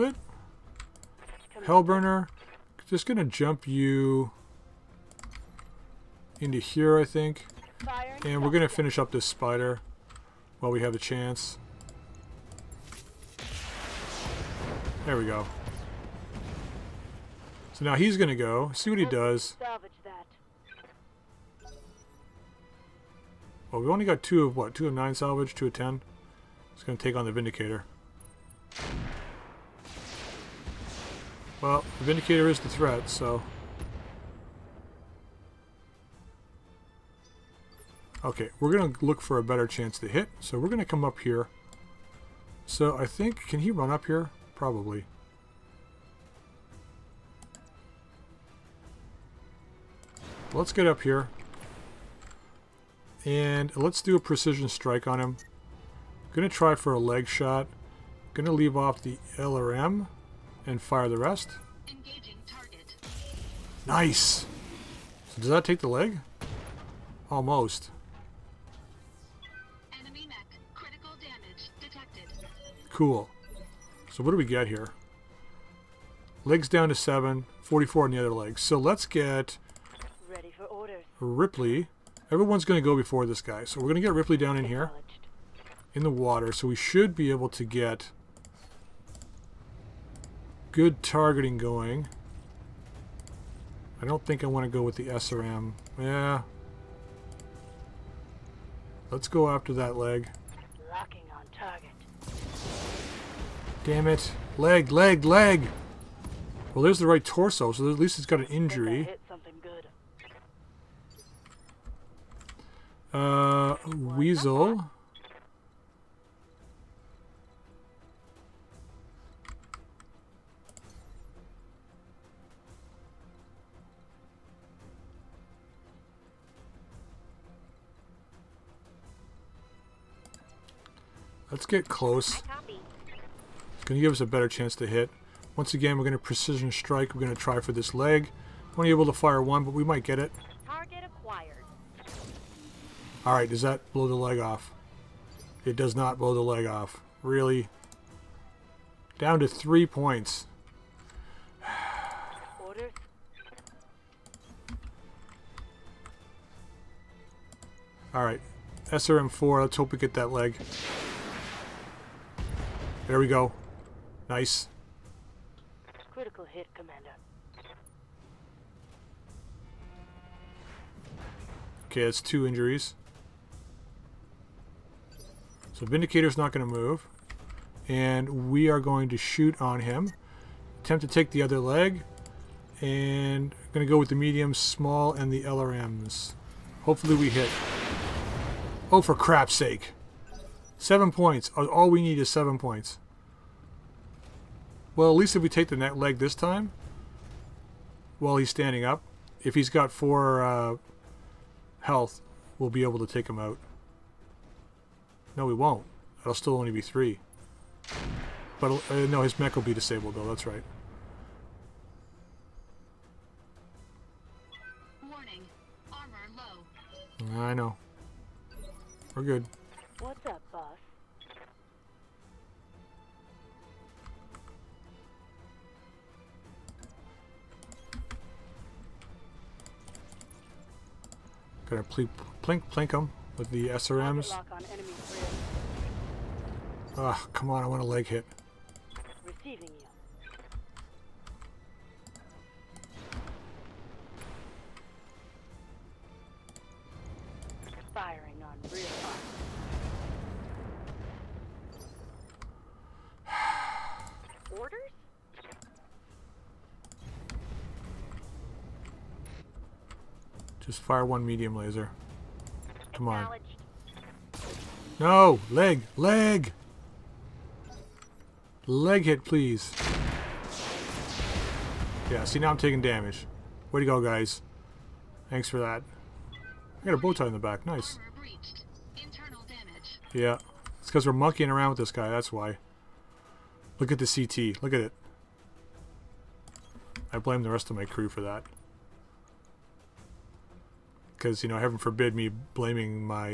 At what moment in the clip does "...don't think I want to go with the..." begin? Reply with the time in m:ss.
1:34.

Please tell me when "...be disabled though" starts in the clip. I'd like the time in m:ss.
3:29.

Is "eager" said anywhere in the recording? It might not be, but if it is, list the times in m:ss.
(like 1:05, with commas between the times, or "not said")
not said.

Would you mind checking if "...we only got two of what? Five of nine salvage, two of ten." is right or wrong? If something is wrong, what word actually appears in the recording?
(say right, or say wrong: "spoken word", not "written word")
wrong: "Two", not "Five".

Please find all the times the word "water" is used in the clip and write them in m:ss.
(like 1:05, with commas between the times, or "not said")
1:26.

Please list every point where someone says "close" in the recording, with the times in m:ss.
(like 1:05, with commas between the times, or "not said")
2:11.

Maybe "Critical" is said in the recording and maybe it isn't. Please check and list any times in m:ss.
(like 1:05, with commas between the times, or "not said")
2:46.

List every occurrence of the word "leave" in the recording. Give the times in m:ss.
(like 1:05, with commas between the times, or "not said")
0:58.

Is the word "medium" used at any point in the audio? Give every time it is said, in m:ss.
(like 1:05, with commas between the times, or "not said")
3:04, 4:21.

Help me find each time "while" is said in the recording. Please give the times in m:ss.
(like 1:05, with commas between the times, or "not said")
0:10, 3:18.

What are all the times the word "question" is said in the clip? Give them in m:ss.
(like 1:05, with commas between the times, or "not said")
not said.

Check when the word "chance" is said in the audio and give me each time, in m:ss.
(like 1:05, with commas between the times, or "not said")
0:10, 0:39, 2:14.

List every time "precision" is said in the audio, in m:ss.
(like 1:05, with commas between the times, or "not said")
0:54, 2:16.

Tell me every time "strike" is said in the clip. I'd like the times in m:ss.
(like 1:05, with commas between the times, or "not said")
0:54, 2:16.